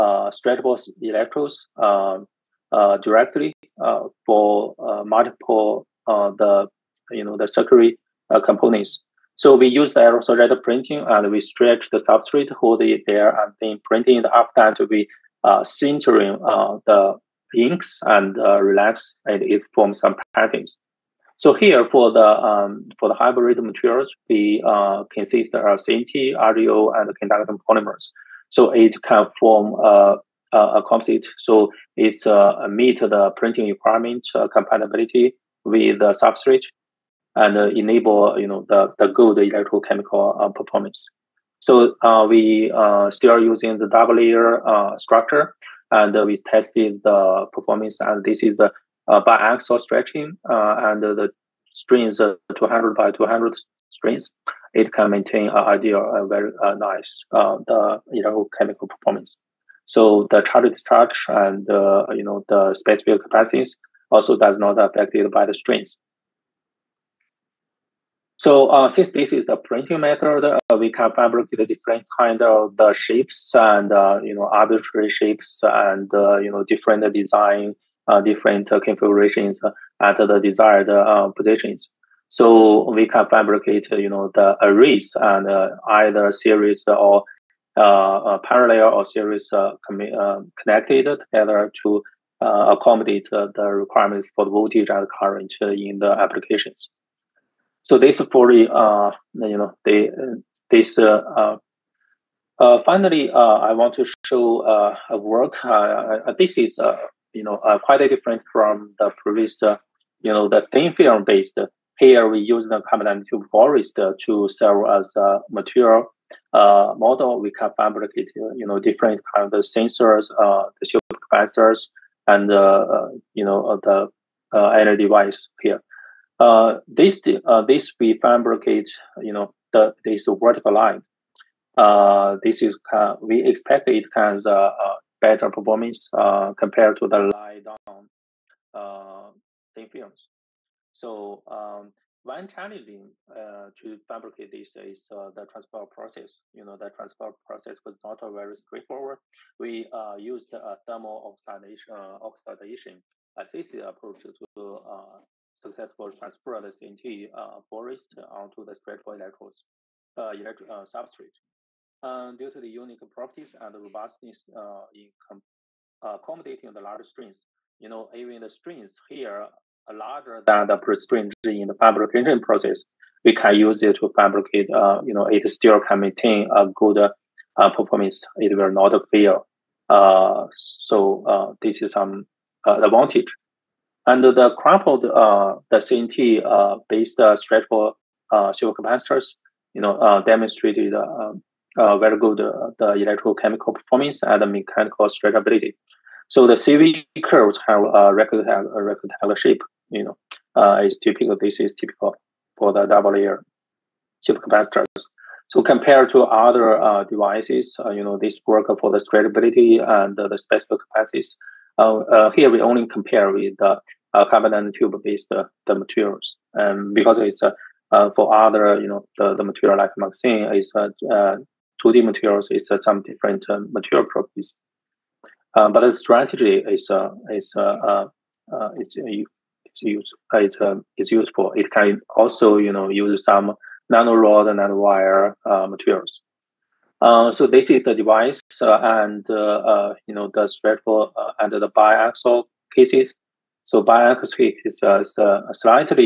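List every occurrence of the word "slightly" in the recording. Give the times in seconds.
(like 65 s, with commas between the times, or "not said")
245 s.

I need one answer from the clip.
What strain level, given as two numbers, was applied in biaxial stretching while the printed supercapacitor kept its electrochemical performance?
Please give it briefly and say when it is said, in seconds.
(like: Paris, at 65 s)
200 by 200, at 52 s.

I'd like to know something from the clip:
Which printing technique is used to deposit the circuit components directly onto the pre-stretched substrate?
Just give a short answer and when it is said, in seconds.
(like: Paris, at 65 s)
aerosol printing, at 9 s.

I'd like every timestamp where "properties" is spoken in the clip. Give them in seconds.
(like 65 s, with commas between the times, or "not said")
163 s, 224 s.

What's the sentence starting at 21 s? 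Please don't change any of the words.
So here for the um, for the hybrid materials, we uh, consist of CNT, rGO, and conductive polymers.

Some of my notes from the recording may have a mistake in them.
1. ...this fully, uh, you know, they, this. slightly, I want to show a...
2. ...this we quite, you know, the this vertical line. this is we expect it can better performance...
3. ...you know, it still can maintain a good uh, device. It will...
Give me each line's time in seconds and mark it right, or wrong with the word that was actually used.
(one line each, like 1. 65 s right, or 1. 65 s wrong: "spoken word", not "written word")
1. 97 s wrong: "finally", not "slightly"
2. 127 s wrong: "fabricate", not "quite"
3. 175 s wrong: "performance", not "device".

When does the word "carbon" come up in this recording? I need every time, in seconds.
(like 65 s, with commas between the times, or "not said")
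112 s, 214 s.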